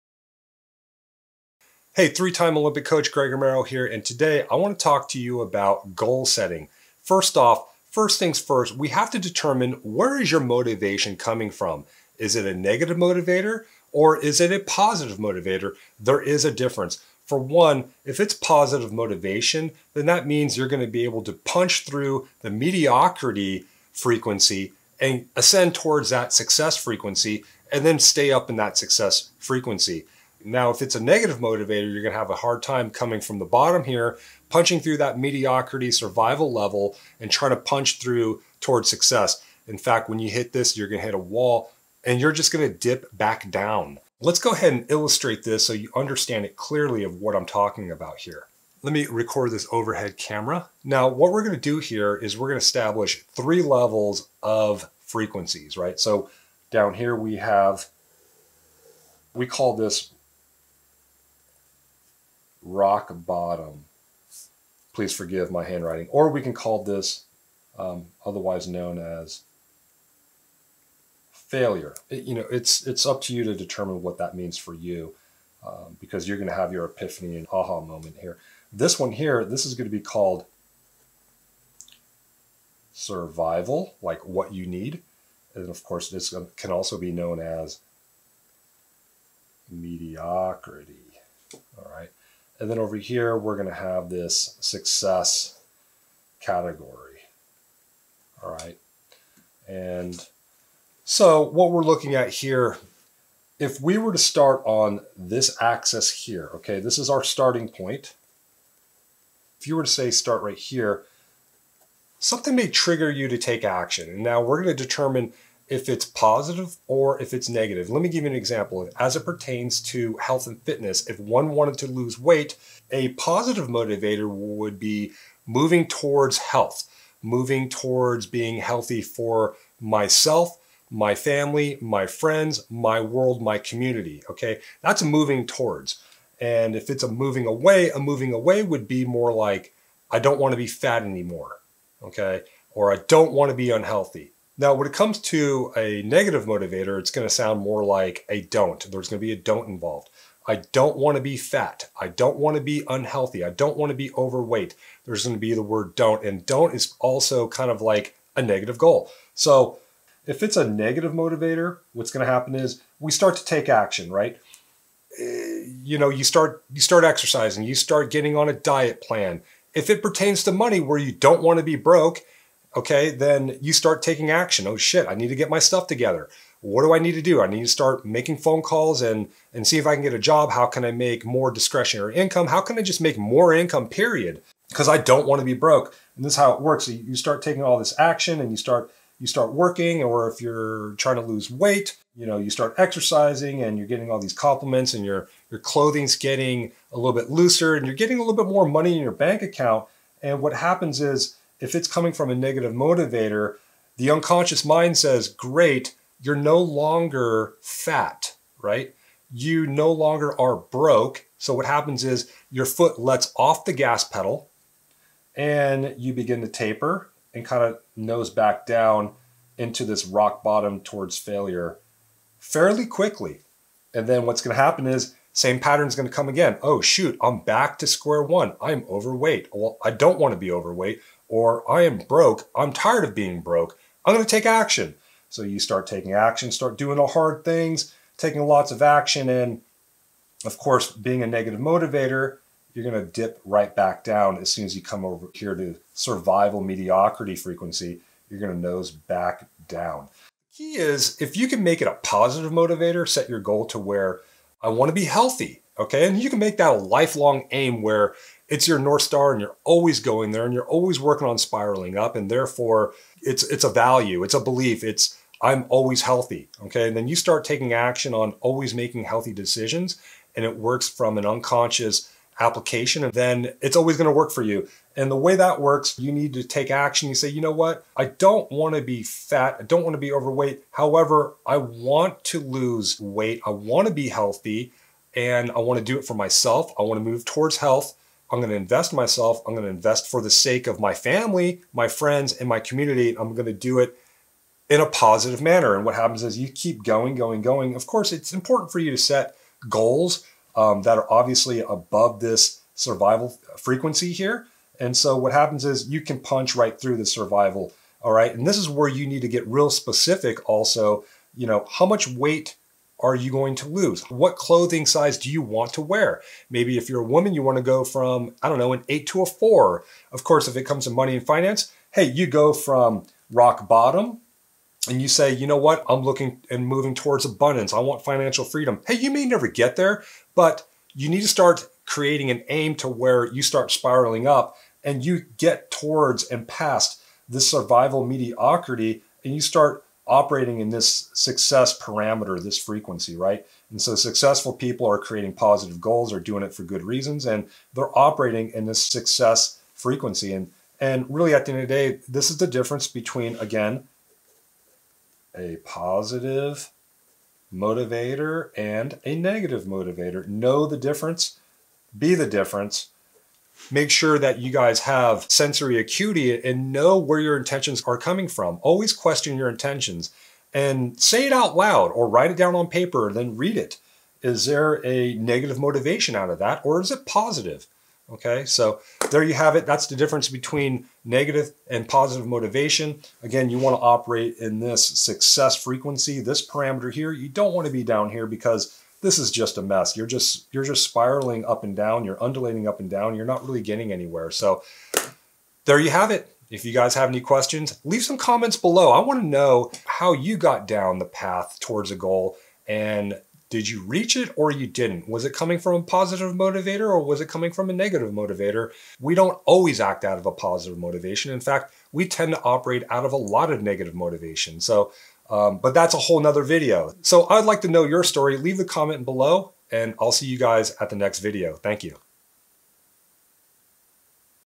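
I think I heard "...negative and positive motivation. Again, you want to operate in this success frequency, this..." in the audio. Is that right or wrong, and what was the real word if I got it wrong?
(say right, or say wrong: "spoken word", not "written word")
right.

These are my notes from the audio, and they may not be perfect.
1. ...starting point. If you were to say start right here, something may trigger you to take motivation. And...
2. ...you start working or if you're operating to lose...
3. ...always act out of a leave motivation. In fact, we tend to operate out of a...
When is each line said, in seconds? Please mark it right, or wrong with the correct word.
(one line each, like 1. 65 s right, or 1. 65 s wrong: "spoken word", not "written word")
1. 107 s wrong: "action", not "motivation"
2. 189 s wrong: "trying", not "operating"
3. 409 s wrong: "positive", not "leave".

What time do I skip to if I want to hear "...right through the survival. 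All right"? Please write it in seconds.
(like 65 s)
306 s.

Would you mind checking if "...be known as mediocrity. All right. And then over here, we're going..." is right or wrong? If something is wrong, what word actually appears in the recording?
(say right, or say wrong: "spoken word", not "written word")
right.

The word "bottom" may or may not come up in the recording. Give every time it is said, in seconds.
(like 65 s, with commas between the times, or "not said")
33 s, 63 s, 220 s, 323 s.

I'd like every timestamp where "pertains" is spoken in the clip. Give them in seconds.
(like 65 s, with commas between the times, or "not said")
119 s, 170 s.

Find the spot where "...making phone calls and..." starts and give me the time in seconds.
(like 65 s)
178 s.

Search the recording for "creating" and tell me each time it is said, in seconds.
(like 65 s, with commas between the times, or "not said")
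331 s, 344 s.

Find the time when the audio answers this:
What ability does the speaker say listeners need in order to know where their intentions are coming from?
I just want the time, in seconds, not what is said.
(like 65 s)
365 s.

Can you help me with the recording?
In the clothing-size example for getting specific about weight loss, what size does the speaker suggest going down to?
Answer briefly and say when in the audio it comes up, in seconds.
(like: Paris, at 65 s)
4, at 319 s.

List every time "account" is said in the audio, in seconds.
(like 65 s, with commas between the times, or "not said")
199 s.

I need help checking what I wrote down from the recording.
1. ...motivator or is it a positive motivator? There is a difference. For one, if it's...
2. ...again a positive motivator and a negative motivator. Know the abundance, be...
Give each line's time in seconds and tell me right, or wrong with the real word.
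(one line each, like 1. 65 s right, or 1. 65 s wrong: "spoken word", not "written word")
1. 12 s right
2. 353 s wrong: "difference", not "abundance".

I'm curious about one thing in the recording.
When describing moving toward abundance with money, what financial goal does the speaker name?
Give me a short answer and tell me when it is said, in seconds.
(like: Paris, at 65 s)
financial freedom, at 328 s.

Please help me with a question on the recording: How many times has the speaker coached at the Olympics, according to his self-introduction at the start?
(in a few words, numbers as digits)
3.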